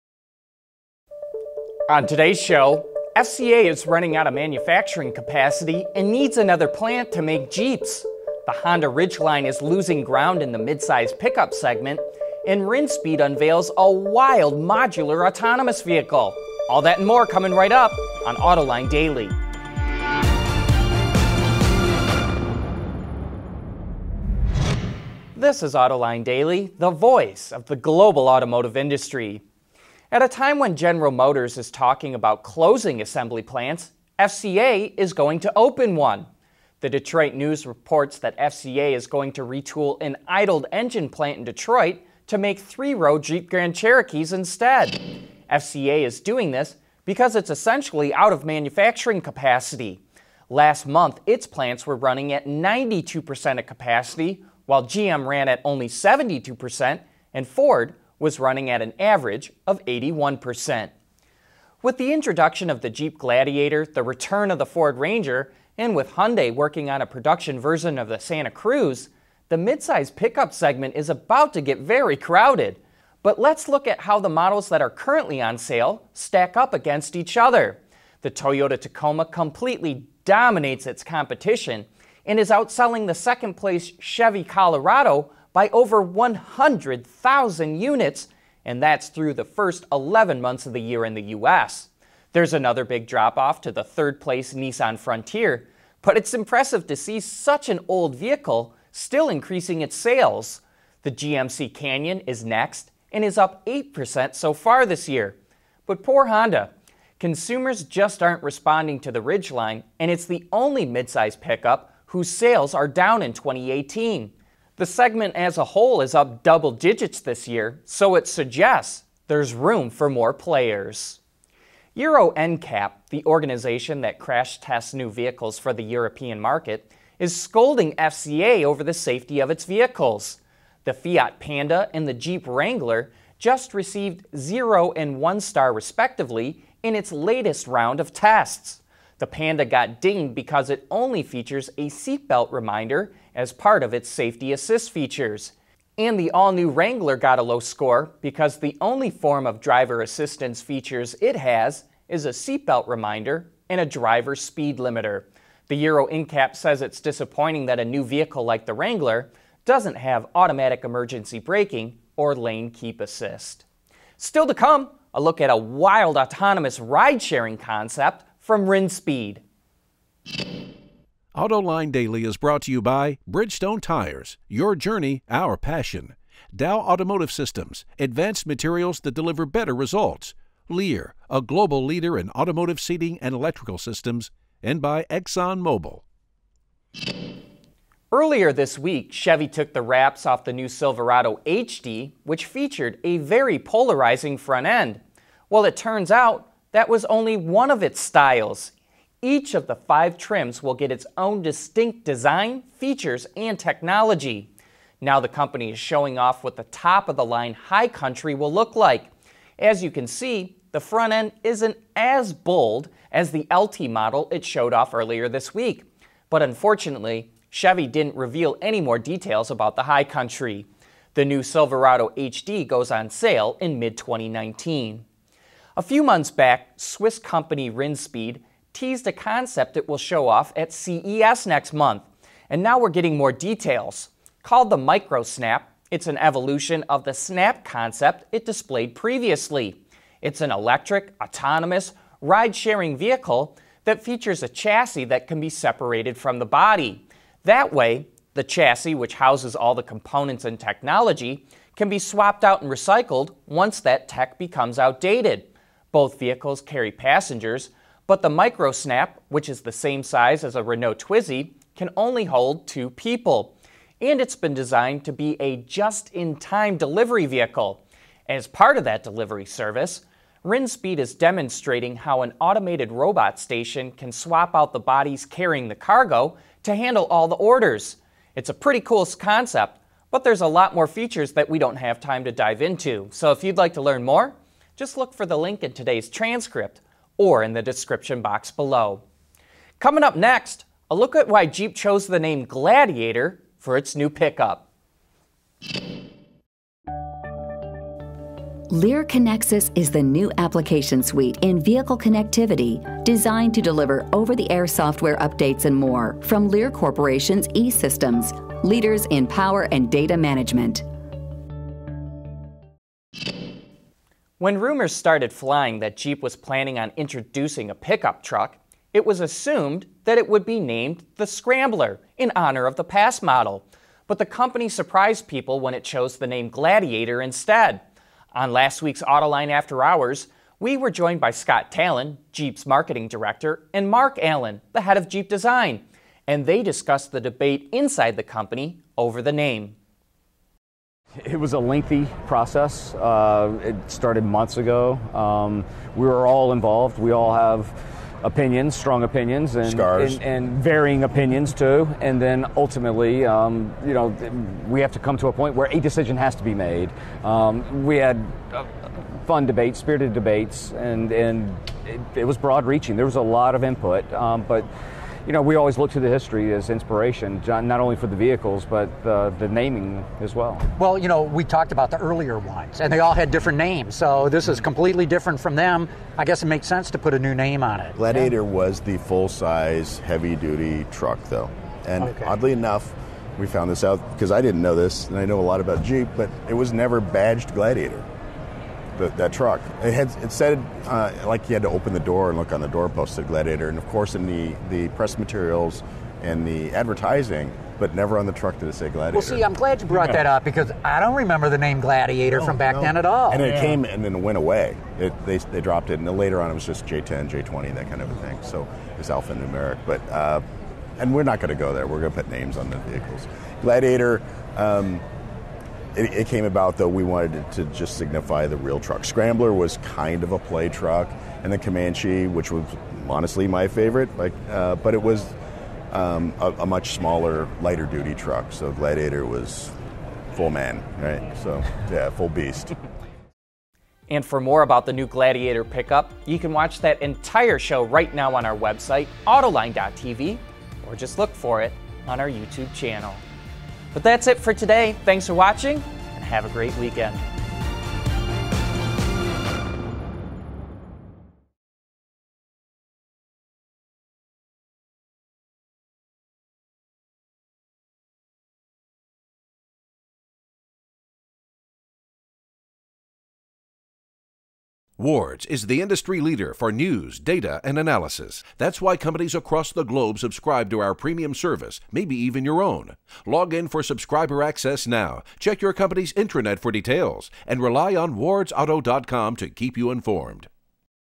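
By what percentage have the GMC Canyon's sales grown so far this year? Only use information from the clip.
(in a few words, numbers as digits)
8%.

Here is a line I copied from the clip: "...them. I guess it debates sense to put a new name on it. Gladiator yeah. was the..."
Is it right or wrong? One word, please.
wrong.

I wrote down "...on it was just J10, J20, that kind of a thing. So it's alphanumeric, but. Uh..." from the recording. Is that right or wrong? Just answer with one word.
right.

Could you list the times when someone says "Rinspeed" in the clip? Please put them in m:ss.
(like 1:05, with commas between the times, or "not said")
0:12, 2:48, 3:47, 4:30.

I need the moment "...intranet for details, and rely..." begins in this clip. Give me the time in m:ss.
7:56.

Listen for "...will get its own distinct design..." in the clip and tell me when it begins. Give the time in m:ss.
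3:20.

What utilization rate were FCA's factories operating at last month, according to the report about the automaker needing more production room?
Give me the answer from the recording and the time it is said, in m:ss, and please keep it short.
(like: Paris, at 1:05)
92%, at 0:52.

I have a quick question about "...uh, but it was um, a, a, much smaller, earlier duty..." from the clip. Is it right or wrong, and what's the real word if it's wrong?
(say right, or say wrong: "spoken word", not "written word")
wrong: "lighter", not "earlier".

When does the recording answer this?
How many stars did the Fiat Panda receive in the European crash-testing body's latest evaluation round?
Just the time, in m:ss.
2:14.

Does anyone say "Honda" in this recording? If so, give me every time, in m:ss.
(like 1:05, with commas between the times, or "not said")
0:08, 1:46.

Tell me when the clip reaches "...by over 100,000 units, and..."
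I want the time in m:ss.
1:25.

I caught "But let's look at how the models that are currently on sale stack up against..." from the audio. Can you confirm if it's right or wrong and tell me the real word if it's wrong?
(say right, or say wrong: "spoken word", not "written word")
right.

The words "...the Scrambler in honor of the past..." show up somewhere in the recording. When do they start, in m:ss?
5:21.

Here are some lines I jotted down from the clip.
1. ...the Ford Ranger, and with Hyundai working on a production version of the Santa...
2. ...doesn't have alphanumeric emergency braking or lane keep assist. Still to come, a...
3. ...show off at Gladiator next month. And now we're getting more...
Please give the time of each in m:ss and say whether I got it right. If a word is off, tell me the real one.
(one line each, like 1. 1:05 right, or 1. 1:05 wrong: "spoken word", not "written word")
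1. 1:04 right
2. 2:39 wrong: "automatic", not "alphanumeric"
3. 3:49 wrong: "CES", not "Gladiator".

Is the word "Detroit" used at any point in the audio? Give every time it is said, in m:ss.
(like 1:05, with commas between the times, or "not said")
0:36, 0:41.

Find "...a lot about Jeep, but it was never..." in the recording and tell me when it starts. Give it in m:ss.
6:25.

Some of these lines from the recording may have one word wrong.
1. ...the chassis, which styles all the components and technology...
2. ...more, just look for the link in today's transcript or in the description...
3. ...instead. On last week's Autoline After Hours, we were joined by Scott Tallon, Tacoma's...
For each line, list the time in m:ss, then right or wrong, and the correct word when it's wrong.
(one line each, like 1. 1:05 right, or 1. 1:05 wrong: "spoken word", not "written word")
1. 4:08 wrong: "houses", not "styles"
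2. 4:44 right
3. 5:27 wrong: "Jeep", not "Tacoma".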